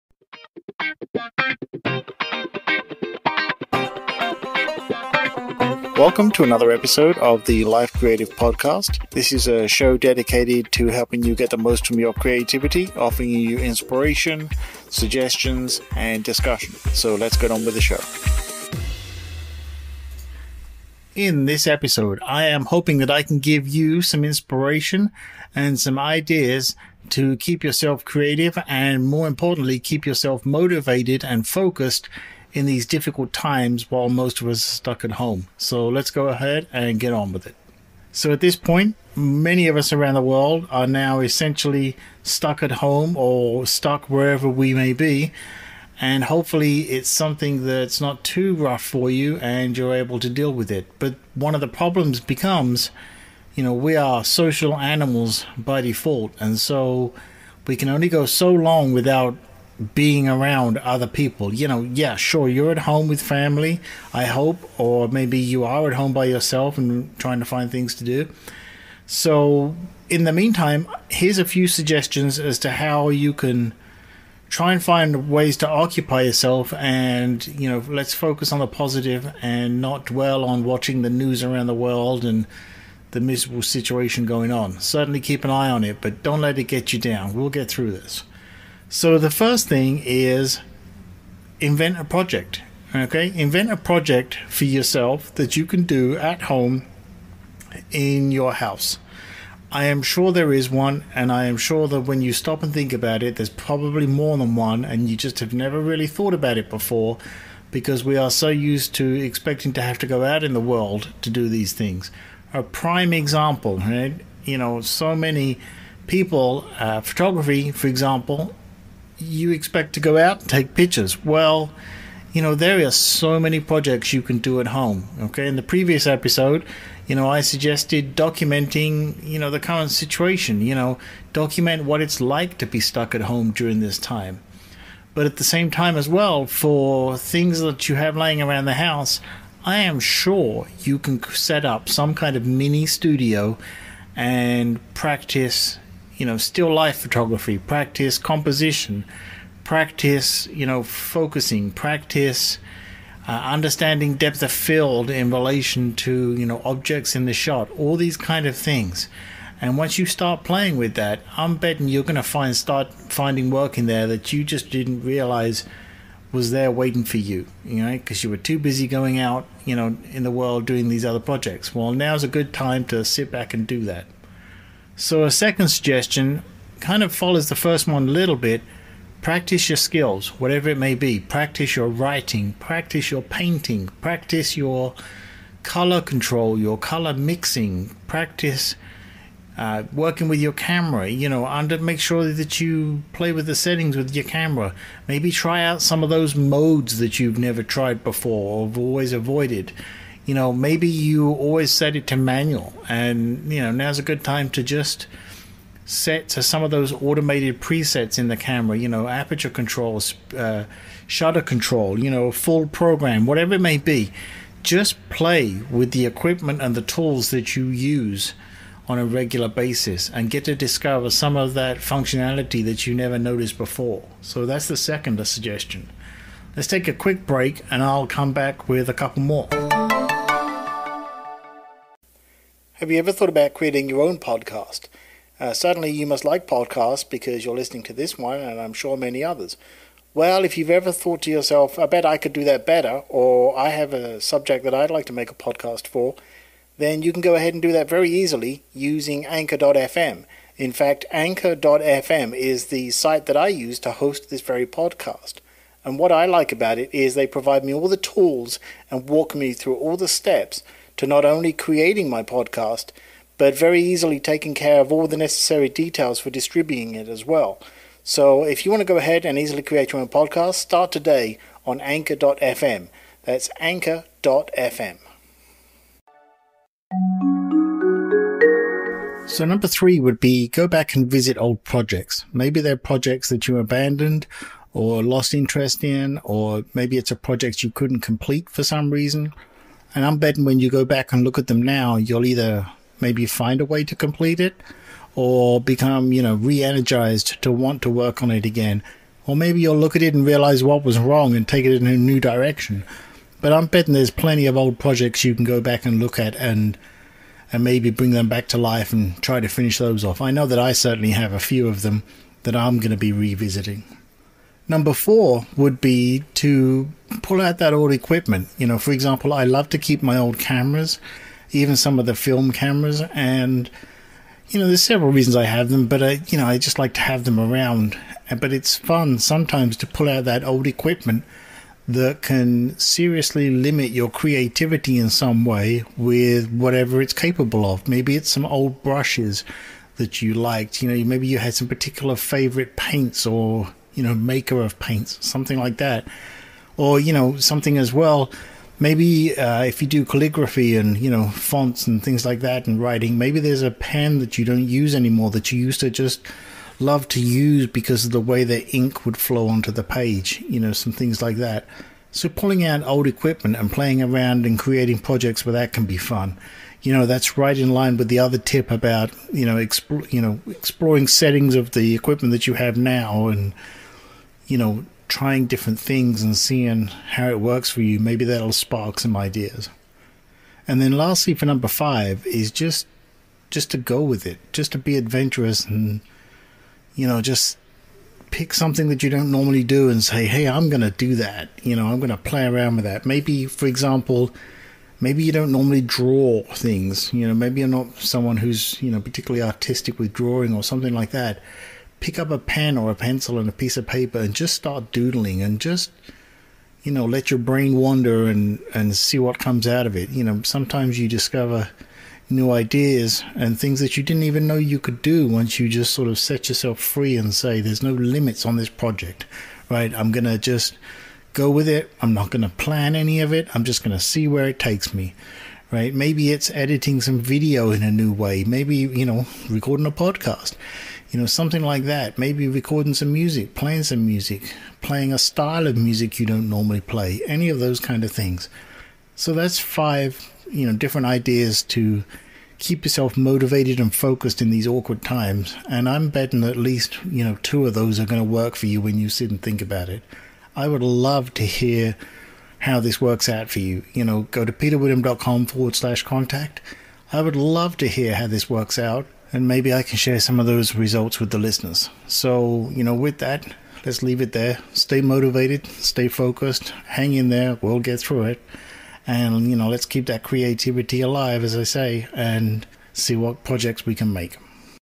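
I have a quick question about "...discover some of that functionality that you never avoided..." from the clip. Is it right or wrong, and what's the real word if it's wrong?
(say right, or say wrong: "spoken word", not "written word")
wrong: "noticed", not "avoided".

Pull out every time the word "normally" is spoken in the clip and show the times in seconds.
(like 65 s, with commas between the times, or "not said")
389 s, 395 s, 436 s.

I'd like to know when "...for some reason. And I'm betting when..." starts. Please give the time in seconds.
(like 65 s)
288 s.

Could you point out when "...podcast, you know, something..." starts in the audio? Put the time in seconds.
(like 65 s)
429 s.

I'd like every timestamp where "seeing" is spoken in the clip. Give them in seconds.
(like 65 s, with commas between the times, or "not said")
376 s.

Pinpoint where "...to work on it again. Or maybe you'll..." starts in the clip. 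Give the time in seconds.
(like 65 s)
297 s.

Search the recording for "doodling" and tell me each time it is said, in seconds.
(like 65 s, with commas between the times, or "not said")
404 s.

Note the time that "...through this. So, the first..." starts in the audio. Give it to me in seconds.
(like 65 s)
87 s.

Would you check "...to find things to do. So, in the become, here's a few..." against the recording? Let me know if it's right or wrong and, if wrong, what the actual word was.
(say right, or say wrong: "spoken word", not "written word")
wrong: "meantime", not "become".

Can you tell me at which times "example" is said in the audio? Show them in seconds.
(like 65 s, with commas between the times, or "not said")
113 s, 117 s, 318 s, 393 s.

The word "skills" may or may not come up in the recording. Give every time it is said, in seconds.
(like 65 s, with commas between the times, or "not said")
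179 s.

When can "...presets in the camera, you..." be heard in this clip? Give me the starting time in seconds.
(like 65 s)
207 s.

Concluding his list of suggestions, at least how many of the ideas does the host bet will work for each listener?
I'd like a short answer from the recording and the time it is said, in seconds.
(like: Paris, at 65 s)
2, at 447 s.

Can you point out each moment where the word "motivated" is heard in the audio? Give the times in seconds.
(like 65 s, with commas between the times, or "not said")
30 s, 443 s, 465 s.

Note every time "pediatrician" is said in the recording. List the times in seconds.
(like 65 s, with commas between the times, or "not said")
not said.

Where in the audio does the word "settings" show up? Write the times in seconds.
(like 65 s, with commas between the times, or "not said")
193 s, 371 s.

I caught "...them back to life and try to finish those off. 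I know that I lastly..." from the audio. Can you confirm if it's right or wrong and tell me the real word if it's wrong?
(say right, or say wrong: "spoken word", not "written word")
wrong: "certainly", not "lastly".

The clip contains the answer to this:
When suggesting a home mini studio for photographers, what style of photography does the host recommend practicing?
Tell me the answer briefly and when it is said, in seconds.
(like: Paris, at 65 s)
still life photography, at 146 s.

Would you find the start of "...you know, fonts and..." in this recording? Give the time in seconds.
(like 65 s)
350 s.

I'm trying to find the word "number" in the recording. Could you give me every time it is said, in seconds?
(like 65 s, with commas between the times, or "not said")
279 s, 314 s, 381 s.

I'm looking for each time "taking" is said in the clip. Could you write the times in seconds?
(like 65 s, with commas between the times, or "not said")
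264 s.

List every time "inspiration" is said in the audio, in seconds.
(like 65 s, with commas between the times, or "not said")
13 s, 24 s.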